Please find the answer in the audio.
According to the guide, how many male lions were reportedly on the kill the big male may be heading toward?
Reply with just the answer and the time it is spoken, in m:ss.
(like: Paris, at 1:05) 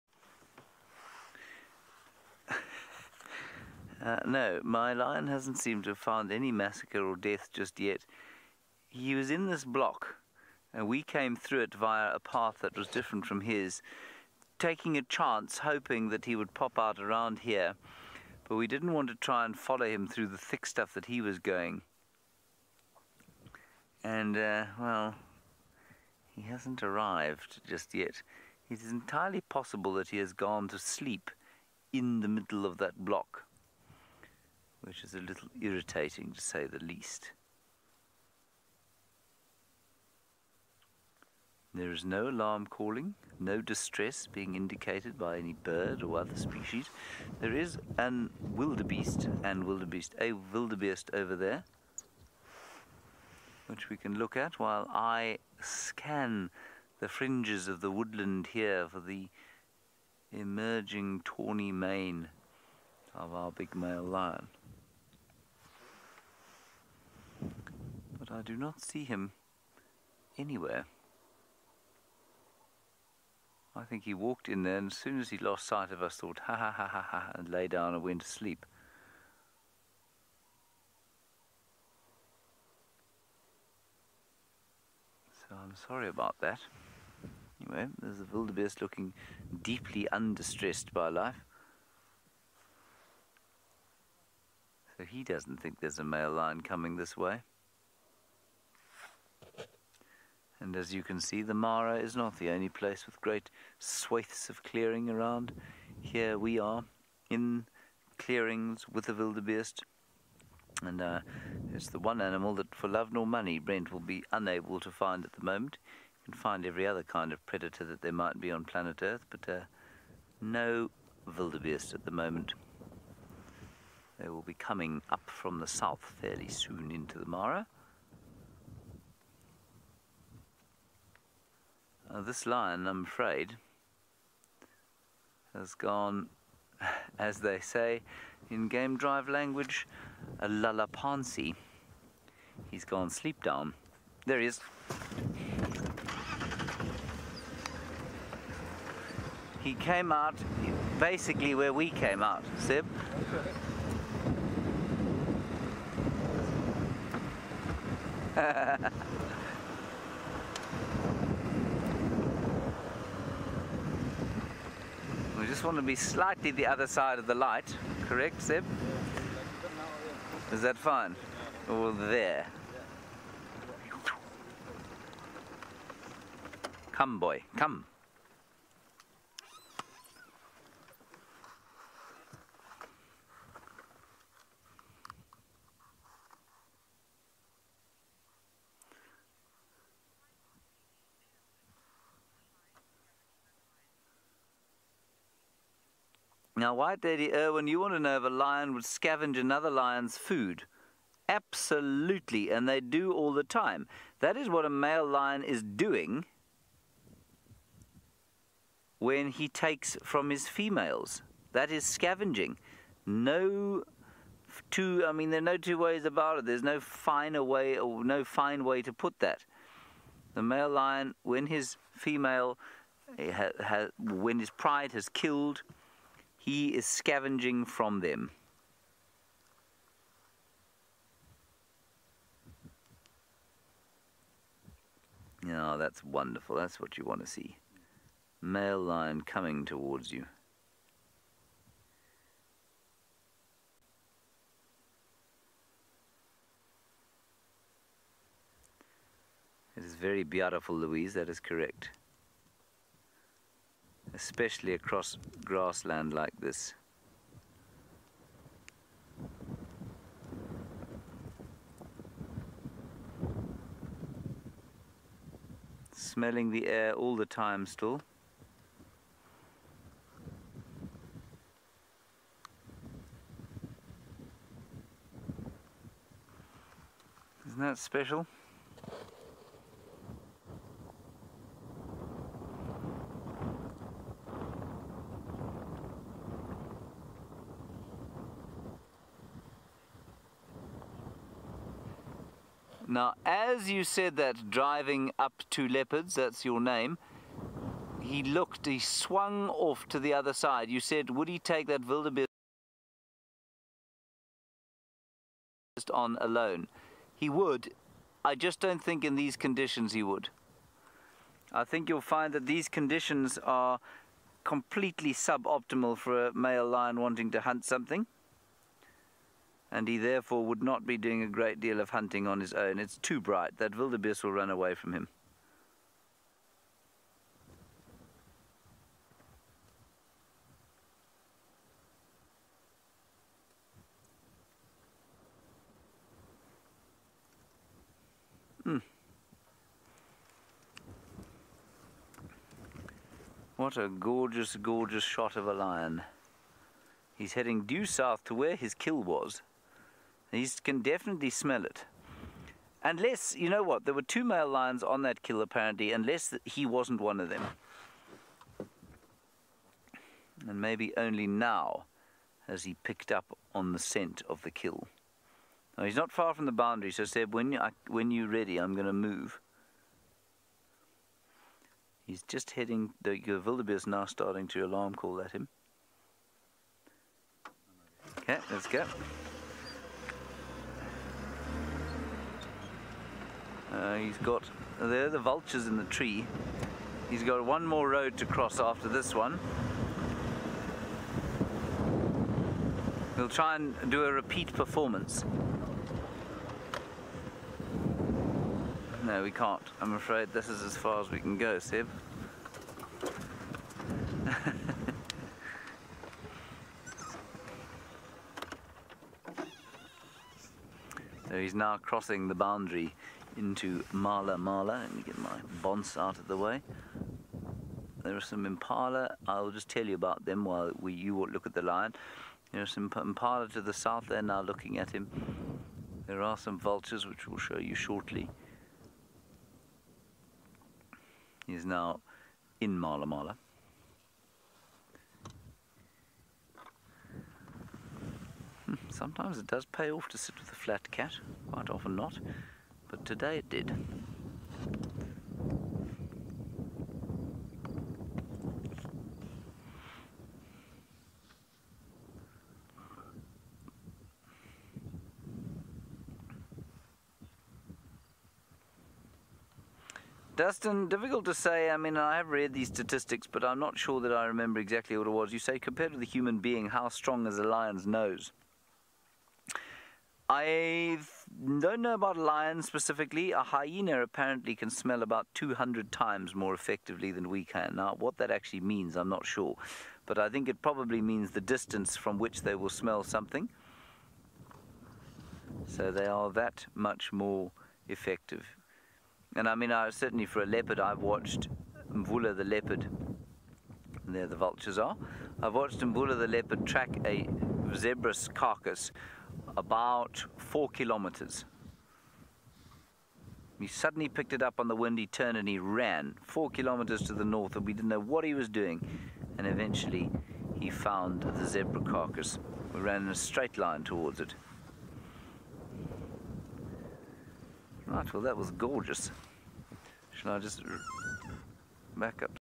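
2, at 5:54.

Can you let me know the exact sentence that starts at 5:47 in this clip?
He's heading due south to where his kill was.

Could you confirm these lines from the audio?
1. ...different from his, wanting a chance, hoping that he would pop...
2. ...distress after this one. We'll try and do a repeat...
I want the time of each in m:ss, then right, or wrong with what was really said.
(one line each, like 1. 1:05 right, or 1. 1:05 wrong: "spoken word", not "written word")
1. 0:12 wrong: "taking", not "wanting"
2. 6:28 wrong: "cross", not "distress".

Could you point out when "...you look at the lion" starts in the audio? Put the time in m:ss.
7:00.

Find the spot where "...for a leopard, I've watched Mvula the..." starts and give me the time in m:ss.
8:10.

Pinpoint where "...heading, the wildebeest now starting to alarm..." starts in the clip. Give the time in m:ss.
6:12.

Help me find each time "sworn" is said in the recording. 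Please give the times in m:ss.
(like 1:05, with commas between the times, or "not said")
not said.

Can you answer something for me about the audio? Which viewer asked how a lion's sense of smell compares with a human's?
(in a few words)
Dustin.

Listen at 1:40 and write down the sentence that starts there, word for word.
and as you can see, the Mara is not the only place with great swathes of clearing around.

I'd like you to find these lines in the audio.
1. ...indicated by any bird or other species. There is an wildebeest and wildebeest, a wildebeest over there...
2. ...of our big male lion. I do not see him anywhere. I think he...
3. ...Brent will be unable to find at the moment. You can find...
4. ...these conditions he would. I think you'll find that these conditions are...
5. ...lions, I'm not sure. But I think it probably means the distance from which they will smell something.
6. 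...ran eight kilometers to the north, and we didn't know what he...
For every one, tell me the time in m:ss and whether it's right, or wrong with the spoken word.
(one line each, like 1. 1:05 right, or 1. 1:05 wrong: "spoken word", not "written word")
1. 0:44 right
2. 1:03 right
3. 1:53 right
4. 5:09 right
5. 7:58 wrong: "means", not "lions"
6. 8:25 wrong: "four", not "eight".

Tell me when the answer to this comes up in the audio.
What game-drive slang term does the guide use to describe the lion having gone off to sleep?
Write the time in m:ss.
2:20.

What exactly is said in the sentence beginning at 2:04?
They will be coming up from the south fairly soon into the Mara.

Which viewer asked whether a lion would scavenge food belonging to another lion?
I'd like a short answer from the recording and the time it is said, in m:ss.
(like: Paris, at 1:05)
White Lady Irwin, at 3:16.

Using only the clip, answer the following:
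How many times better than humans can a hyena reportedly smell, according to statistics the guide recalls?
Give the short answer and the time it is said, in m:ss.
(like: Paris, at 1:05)
200, at 7:55.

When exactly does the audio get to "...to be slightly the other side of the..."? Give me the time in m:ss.
2:45.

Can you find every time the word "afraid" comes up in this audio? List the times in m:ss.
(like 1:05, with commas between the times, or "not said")
2:13, 6:39.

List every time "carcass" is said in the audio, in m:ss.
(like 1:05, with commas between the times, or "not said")
8:18, 8:31.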